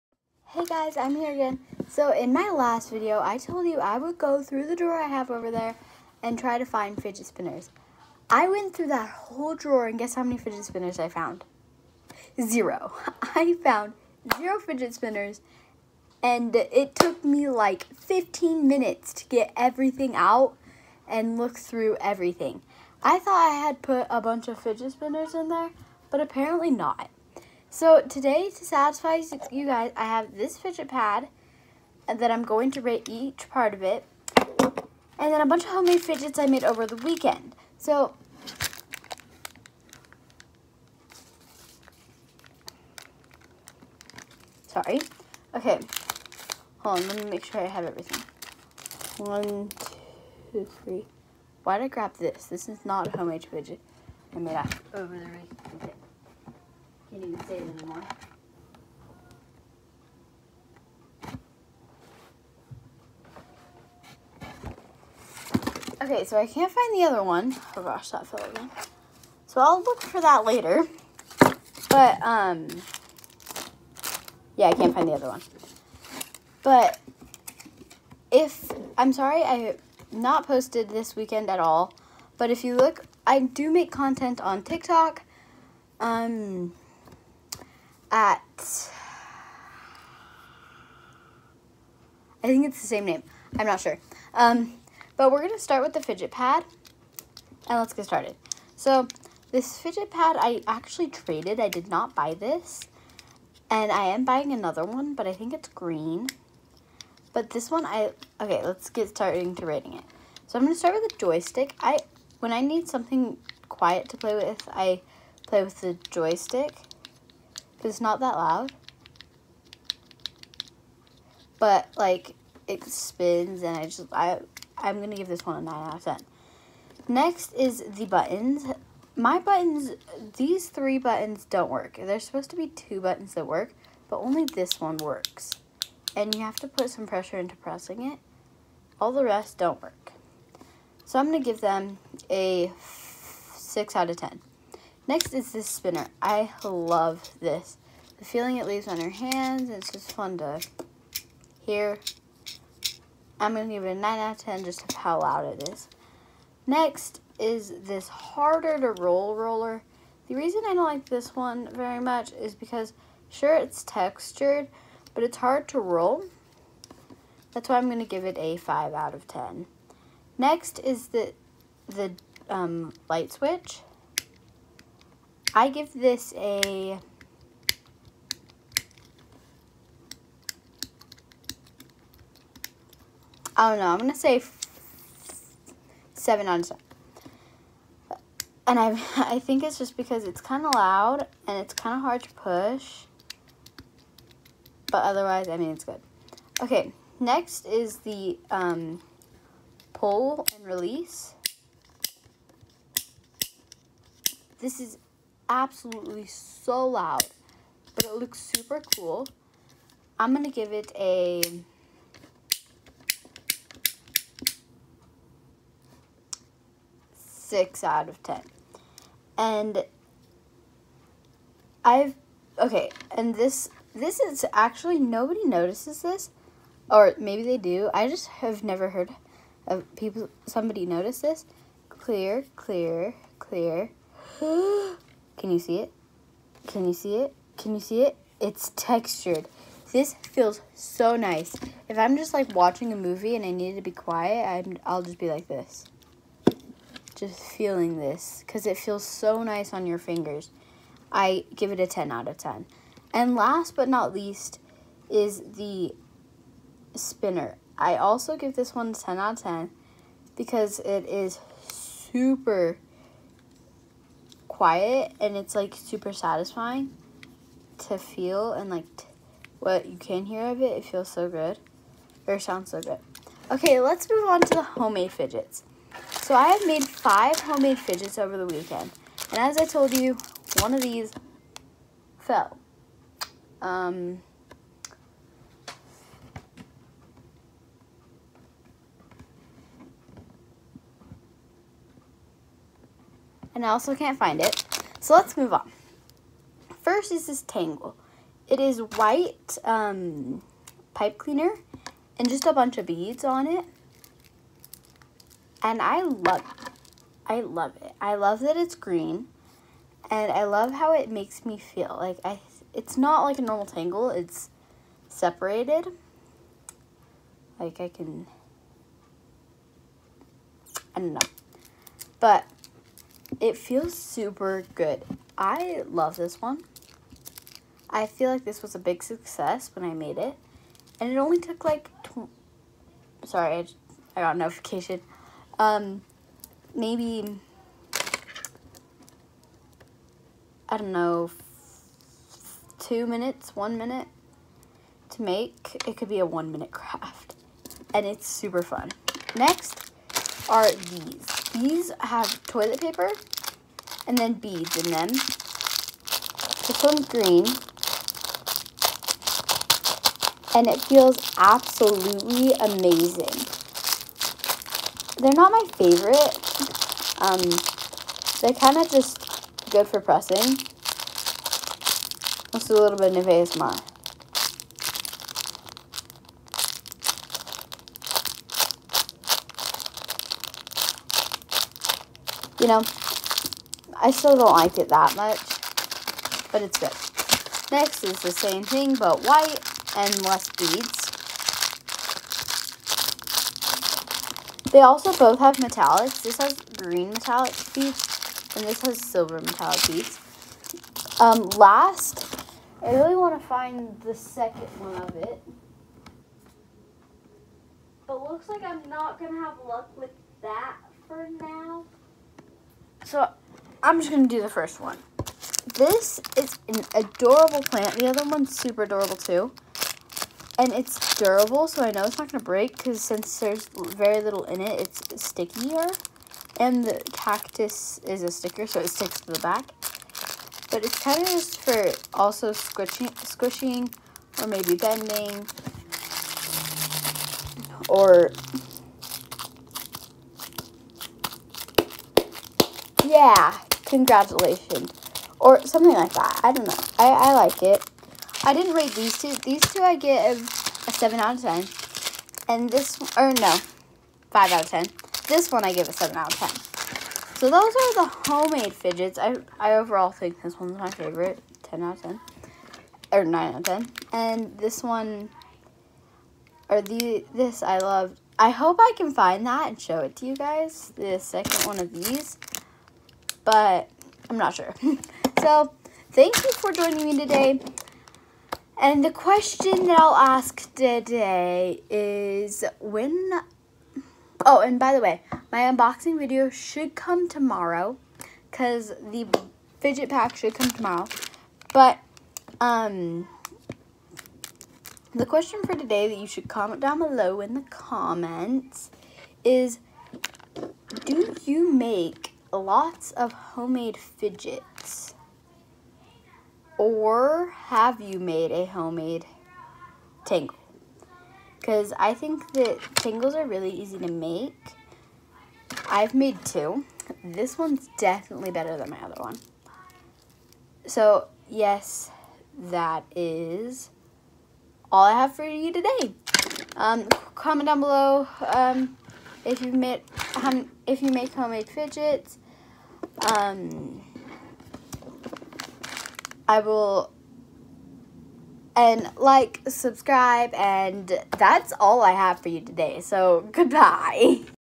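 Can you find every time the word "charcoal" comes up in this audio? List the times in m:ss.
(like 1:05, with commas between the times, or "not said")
not said.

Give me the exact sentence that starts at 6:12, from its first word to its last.
Let's do a little bit of ASMR.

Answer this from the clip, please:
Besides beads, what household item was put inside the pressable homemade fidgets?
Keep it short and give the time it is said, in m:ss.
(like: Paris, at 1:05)
toilet paper, at 5:52.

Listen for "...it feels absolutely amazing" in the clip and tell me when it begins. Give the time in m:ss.
6:00.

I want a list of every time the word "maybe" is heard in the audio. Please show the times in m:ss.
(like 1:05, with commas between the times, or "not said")
3:47, 5:36, 7:14.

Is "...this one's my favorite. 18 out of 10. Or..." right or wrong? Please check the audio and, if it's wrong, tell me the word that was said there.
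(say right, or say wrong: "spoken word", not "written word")
wrong: "10", not "18".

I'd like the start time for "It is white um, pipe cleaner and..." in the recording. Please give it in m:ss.
4:58.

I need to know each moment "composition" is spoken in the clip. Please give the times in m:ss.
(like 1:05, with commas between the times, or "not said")
not said.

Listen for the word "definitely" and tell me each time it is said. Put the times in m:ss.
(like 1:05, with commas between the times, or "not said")
8:37.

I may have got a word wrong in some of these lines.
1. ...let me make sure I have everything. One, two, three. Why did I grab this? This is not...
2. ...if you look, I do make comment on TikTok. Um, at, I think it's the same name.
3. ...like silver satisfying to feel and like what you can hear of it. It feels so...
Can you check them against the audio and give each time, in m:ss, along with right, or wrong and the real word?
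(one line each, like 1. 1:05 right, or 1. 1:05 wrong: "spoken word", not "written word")
1. 0:47 right
2. 1:22 wrong: "content", not "comment"
3. 4:25 wrong: "super", not "silver".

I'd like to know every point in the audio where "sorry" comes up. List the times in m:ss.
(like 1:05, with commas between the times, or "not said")
0:44, 1:19, 5:33.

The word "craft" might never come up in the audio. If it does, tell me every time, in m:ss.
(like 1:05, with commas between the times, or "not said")
5:46.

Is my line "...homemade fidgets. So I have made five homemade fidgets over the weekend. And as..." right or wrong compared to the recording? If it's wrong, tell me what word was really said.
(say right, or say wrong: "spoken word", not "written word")
right.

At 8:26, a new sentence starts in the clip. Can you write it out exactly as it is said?
Or have you made a homemade tangle?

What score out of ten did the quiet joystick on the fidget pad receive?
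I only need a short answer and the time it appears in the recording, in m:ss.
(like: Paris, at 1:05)
9, at 2:05.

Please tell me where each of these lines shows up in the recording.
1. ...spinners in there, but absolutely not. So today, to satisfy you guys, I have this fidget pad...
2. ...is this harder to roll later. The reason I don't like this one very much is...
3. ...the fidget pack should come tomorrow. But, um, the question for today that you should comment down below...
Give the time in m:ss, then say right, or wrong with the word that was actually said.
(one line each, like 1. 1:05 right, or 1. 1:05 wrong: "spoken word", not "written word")
1. 0:24 wrong: "apparently", not "absolutely"
2. 2:37 wrong: "roller", not "later"
3. 8:09 right.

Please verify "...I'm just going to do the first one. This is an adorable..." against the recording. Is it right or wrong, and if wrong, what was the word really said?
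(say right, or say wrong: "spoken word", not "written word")
right.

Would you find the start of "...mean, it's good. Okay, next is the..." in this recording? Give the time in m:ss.
3:15.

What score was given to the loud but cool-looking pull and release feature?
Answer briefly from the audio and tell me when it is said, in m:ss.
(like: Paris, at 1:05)
6 out of 10, at 3:37.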